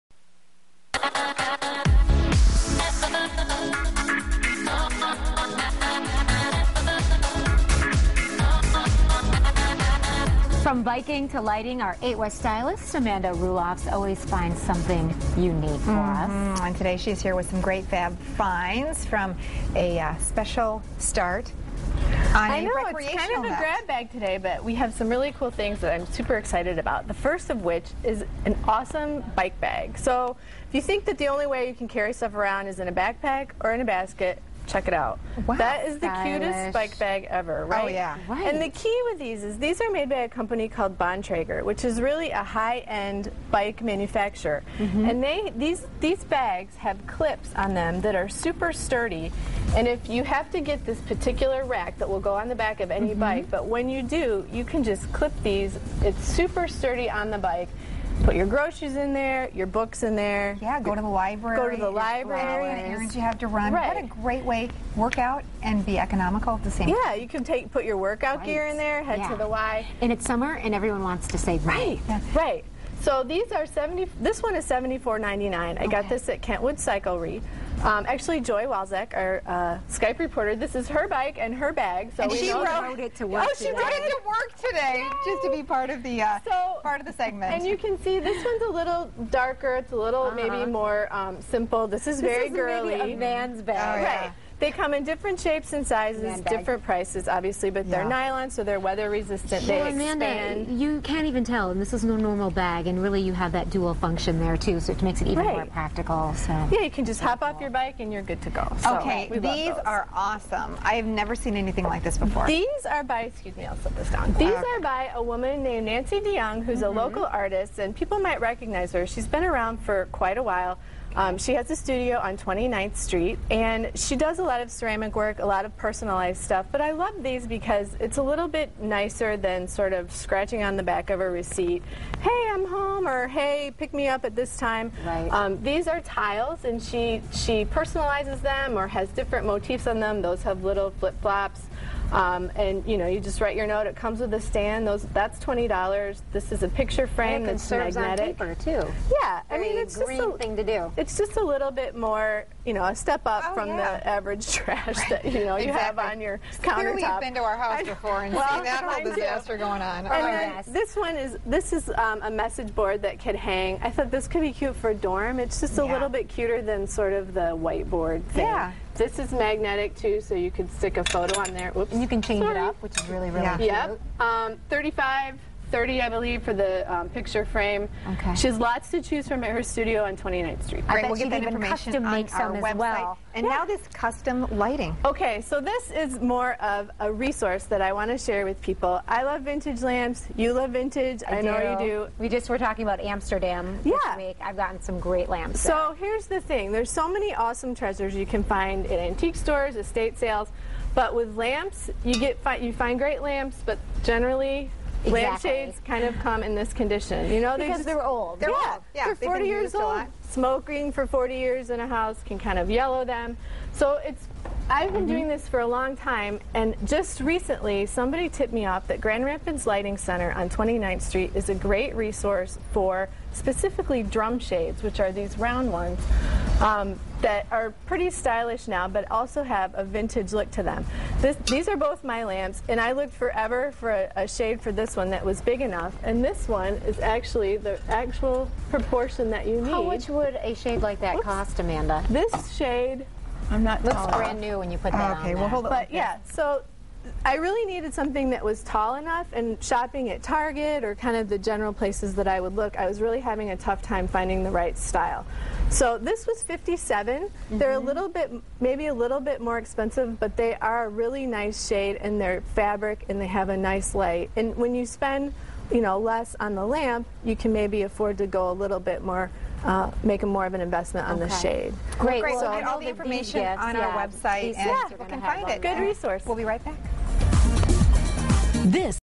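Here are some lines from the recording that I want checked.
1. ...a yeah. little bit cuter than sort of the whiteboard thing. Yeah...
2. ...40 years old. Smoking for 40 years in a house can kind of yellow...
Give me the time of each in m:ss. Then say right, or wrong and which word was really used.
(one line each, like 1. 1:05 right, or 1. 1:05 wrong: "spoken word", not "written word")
1. 2:45 right
2. 3:29 right.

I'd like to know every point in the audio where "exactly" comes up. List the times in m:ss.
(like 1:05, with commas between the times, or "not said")
2:35, 3:25.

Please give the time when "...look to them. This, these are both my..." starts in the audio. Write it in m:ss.
3:50.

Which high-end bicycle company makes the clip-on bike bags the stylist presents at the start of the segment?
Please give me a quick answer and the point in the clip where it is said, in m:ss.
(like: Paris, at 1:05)
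Bontrager, at 0:40.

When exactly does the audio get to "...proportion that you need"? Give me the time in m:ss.
3:58.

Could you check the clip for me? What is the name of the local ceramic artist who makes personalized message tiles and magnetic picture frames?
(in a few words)
Nancy DeYoung.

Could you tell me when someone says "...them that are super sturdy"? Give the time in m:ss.
0:47.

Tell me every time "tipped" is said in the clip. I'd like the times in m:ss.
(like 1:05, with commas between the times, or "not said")
3:38.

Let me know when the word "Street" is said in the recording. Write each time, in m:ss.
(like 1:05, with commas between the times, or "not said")
2:02, 3:00, 3:41.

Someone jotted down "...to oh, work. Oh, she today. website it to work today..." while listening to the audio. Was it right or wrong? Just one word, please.
wrong.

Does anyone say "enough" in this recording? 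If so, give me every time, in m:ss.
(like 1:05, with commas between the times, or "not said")
3:55, 4:08.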